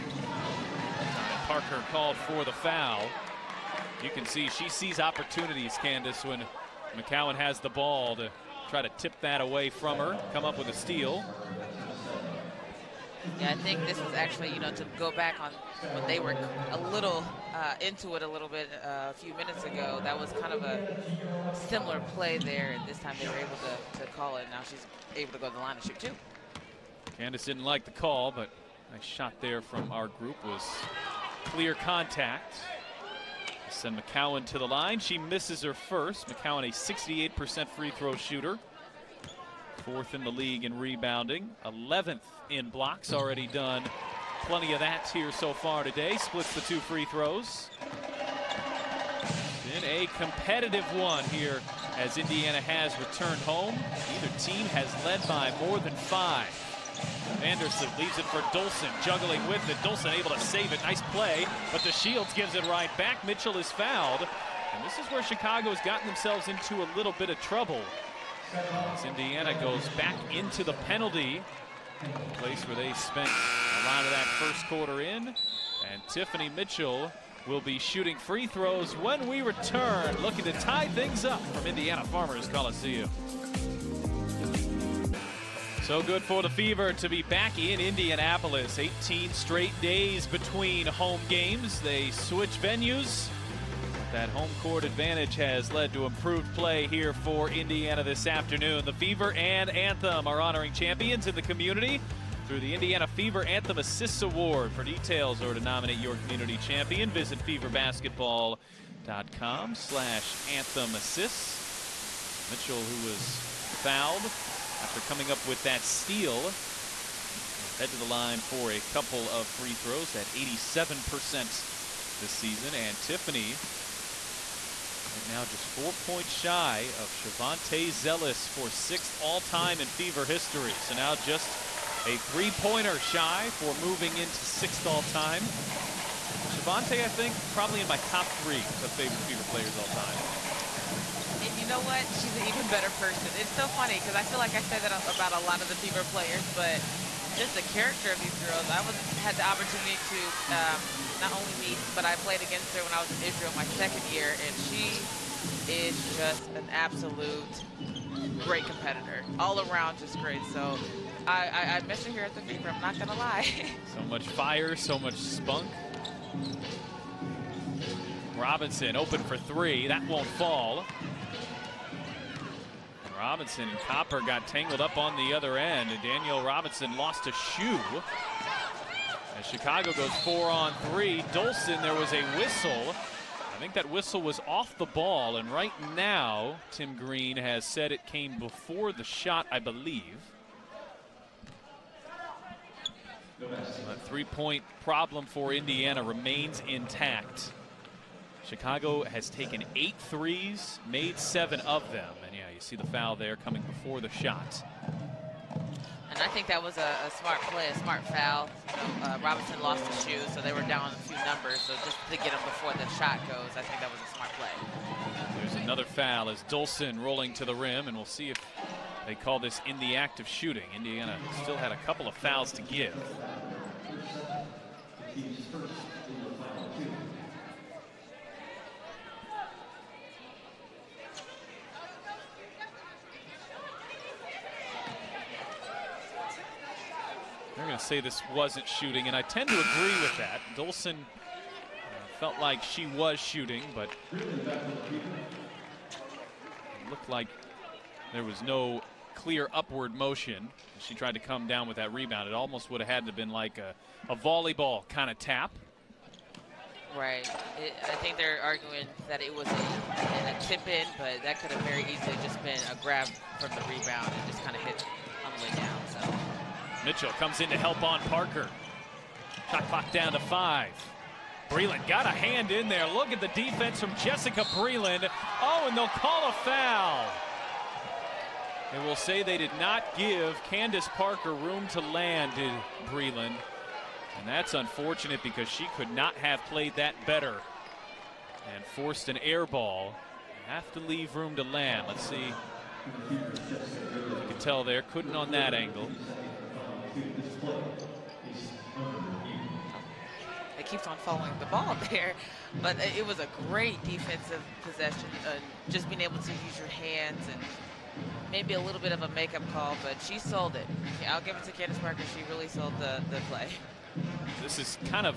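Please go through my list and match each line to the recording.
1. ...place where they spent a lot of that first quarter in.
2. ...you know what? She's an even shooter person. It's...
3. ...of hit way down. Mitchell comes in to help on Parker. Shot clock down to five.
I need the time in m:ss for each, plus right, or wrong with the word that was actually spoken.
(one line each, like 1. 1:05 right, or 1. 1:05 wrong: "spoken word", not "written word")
1. 1:12 right
2. 2:21 wrong: "better", not "shooter"
3. 4:24 right.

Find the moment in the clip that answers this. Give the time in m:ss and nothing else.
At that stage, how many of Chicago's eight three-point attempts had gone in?
3:21.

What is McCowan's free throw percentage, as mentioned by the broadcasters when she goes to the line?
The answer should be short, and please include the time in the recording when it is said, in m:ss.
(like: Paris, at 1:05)
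68%, at 0:36.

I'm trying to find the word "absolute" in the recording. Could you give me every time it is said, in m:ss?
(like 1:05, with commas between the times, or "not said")
2:36.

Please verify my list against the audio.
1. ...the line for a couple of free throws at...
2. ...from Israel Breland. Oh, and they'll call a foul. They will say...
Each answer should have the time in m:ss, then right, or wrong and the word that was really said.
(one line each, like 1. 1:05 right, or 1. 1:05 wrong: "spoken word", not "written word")
1. 1:57 right
2. 4:33 wrong: "Jessica", not "Israel".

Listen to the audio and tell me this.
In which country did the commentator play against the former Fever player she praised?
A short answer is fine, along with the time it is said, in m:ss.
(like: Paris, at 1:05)
Israel, at 2:33.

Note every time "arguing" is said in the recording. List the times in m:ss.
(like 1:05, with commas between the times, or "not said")
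4:18.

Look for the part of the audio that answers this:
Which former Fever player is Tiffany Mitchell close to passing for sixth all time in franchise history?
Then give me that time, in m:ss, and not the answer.
2:07.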